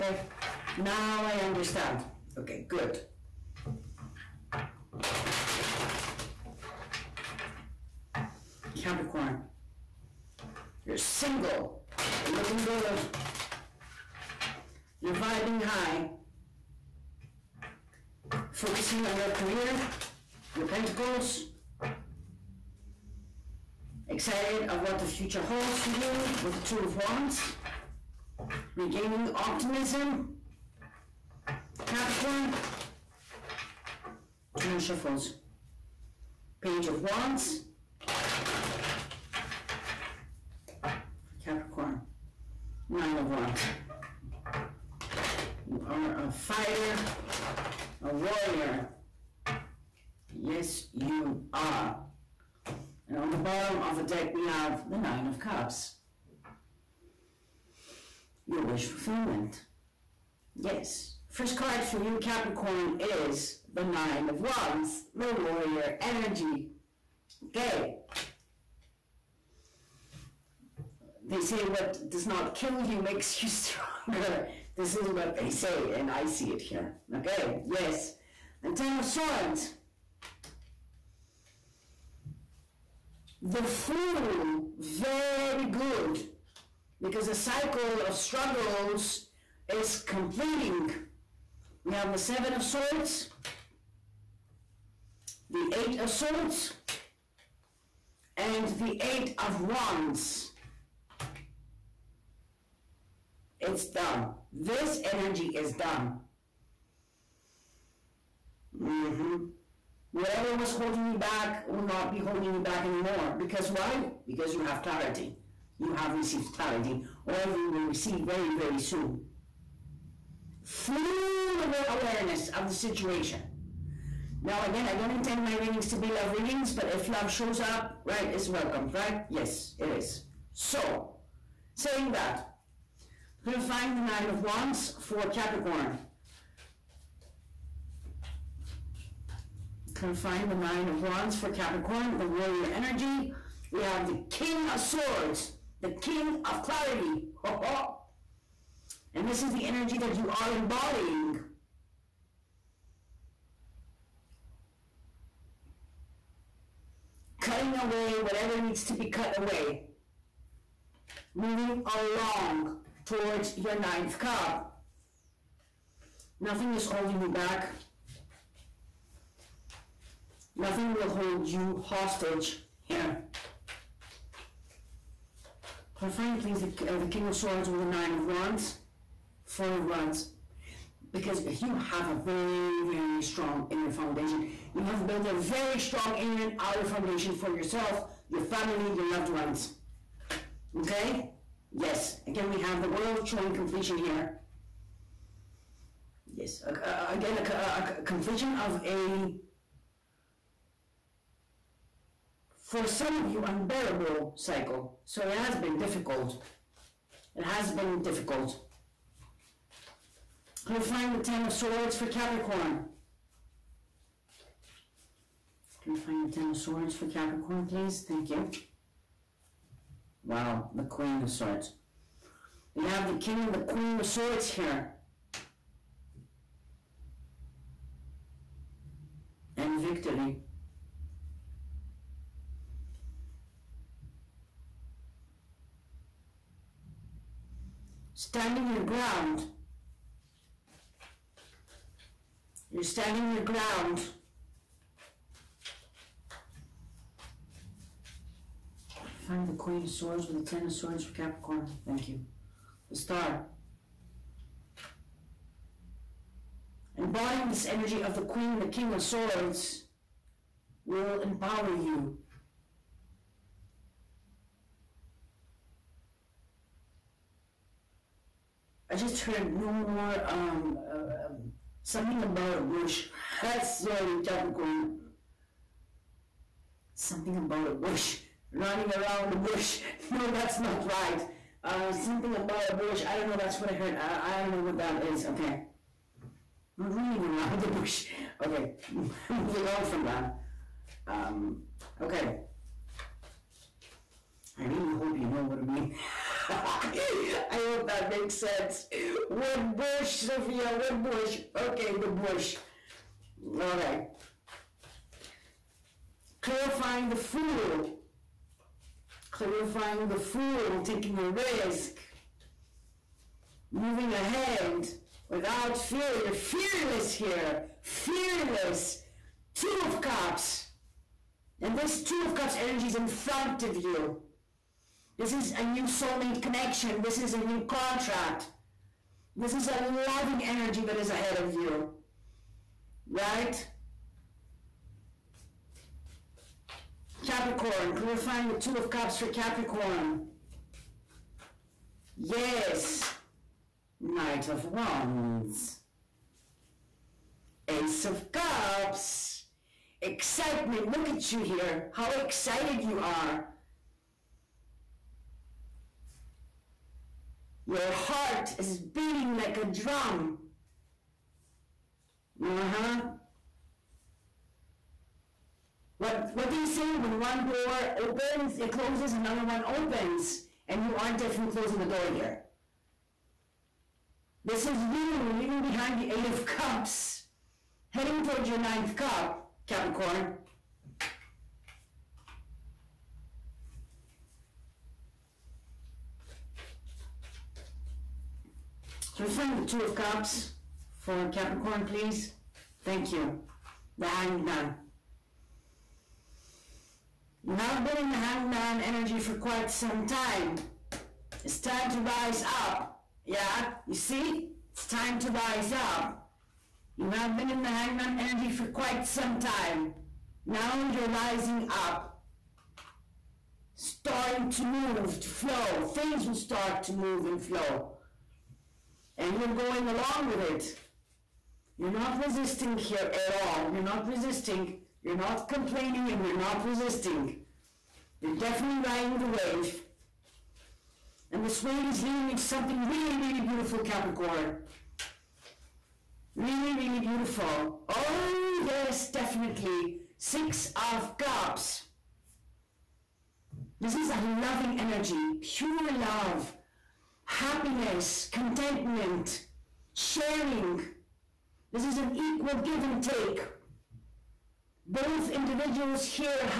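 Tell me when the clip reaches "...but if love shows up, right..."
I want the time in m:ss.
2:06.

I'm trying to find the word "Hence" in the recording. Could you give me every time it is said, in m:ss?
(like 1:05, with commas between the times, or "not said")
not said.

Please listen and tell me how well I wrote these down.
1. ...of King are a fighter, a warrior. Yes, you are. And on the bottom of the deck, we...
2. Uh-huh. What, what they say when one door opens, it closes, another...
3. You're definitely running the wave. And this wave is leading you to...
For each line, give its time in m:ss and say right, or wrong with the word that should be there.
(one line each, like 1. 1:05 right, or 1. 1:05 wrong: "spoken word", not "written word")
1. 0:43 wrong: "Wands", not "King"
2. 6:02 right
3. 7:08 wrong: "riding", not "running".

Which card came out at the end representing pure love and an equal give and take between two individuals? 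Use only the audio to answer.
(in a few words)
Six of Cups.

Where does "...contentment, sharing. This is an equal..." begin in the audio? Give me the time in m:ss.
7:28.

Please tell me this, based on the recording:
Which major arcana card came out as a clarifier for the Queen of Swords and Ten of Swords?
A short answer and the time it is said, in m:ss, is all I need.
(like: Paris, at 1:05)
The Star, at 4:12.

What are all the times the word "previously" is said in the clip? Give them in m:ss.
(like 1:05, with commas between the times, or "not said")
not said.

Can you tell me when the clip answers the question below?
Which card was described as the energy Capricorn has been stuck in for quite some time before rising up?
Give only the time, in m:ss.
6:33.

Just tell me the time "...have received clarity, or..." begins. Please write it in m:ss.
1:55.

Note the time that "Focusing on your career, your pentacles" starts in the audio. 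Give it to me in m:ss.
0:18.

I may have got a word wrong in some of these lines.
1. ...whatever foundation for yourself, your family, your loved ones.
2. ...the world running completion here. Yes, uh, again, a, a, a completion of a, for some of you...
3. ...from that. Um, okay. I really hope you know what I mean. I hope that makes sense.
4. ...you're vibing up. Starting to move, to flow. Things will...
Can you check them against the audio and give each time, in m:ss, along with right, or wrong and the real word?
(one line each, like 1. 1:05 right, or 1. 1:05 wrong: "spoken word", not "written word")
1. 3:06 wrong: "outer", not "whatever"
2. 3:12 wrong: "showing", not "running"
3. 4:49 right
4. 6:50 wrong: "rising", not "vibing".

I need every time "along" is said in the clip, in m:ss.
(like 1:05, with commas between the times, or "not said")
2:41, 6:59.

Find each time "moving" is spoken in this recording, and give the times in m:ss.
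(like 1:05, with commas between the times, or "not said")
2:41, 4:49, 5:13.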